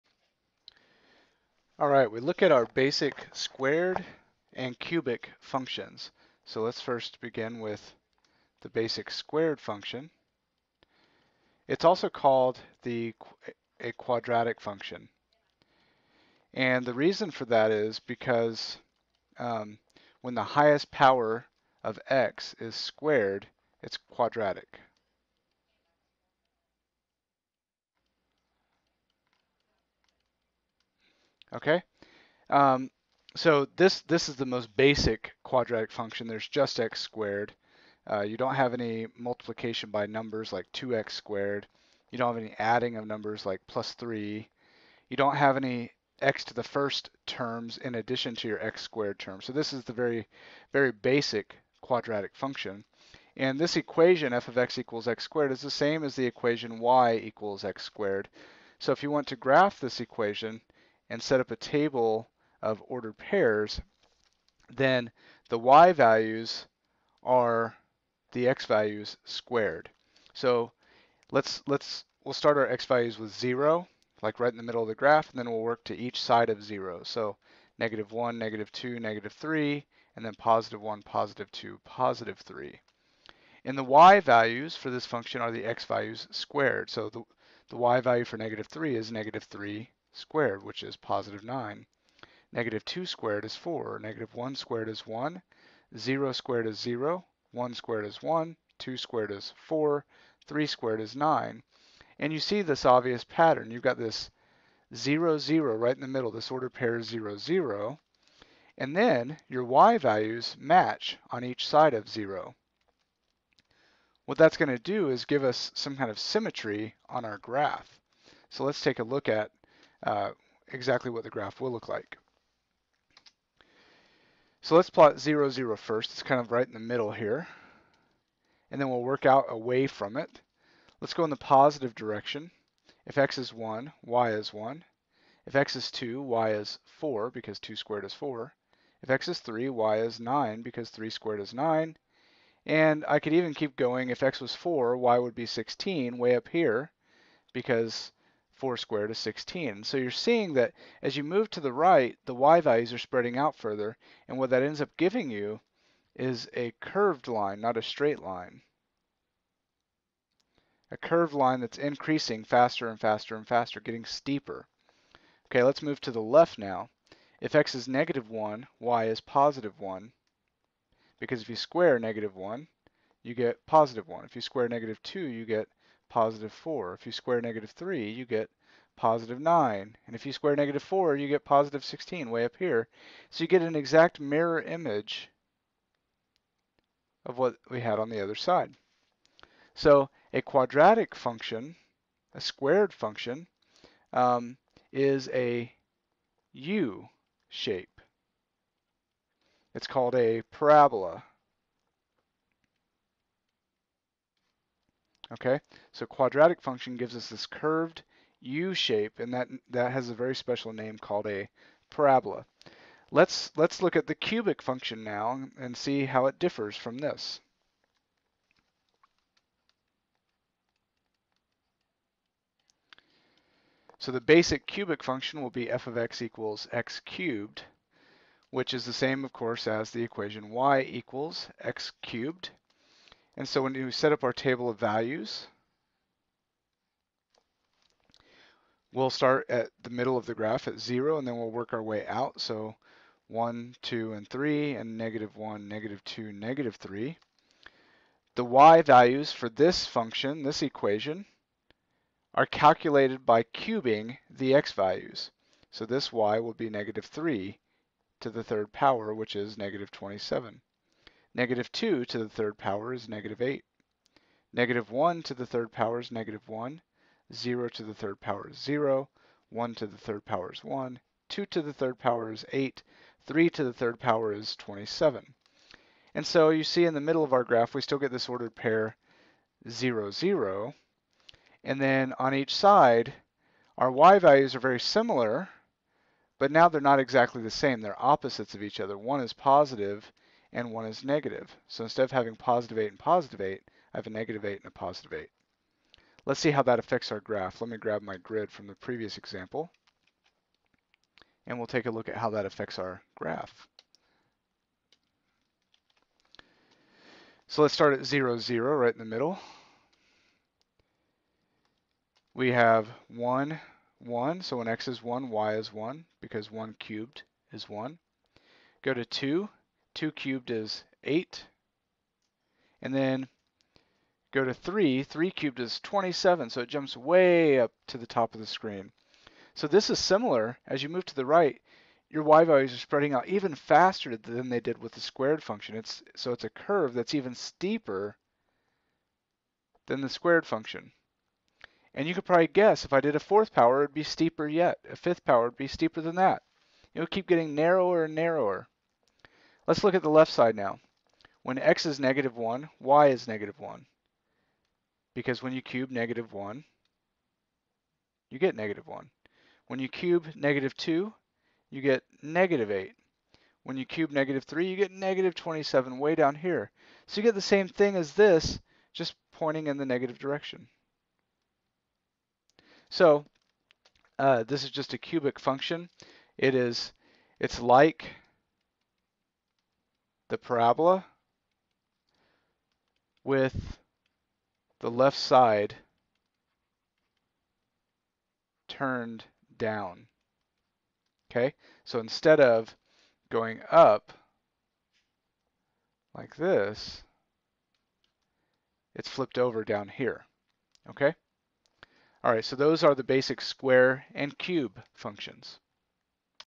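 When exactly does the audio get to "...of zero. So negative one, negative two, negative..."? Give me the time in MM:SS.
01:16.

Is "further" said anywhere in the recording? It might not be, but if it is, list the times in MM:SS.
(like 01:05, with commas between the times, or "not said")
02:33.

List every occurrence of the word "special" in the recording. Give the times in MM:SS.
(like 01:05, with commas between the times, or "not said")
03:30.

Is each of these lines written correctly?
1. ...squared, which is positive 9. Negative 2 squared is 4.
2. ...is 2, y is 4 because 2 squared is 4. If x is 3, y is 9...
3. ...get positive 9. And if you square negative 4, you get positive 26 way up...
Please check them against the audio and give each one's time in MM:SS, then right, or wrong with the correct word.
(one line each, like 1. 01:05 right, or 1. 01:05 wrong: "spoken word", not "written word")
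1. 01:30 right
2. 02:15 right
3. 02:58 wrong: "16", not "26".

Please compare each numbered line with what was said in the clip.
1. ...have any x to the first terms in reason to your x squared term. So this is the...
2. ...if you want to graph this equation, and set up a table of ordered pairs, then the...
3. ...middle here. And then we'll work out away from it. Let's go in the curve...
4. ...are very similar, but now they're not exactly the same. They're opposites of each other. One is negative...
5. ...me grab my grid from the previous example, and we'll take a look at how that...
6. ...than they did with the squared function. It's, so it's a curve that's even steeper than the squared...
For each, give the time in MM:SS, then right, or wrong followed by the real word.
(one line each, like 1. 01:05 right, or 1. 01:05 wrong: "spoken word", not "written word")
1. 00:45 wrong: "addition", not "reason"
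2. 00:58 right
3. 02:06 wrong: "positive", not "curve"
4. 04:44 wrong: "positive", not "negative"
5. 04:57 right
6. 05:34 right.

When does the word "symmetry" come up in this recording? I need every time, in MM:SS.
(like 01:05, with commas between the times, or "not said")
01:56.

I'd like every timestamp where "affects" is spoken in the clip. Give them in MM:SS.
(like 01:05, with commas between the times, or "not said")
04:56, 05:02.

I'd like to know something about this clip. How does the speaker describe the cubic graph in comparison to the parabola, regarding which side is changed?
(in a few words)
left side turned down.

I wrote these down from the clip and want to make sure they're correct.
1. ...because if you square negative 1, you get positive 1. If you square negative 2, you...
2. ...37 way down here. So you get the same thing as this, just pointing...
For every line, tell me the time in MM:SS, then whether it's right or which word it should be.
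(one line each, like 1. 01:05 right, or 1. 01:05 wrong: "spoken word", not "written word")
1. 02:51 right
2. 06:05 wrong: "27", not "37".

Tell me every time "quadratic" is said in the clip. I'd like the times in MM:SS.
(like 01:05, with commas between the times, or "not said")
00:13, 00:23, 00:35, 00:51, 03:10, 03:26.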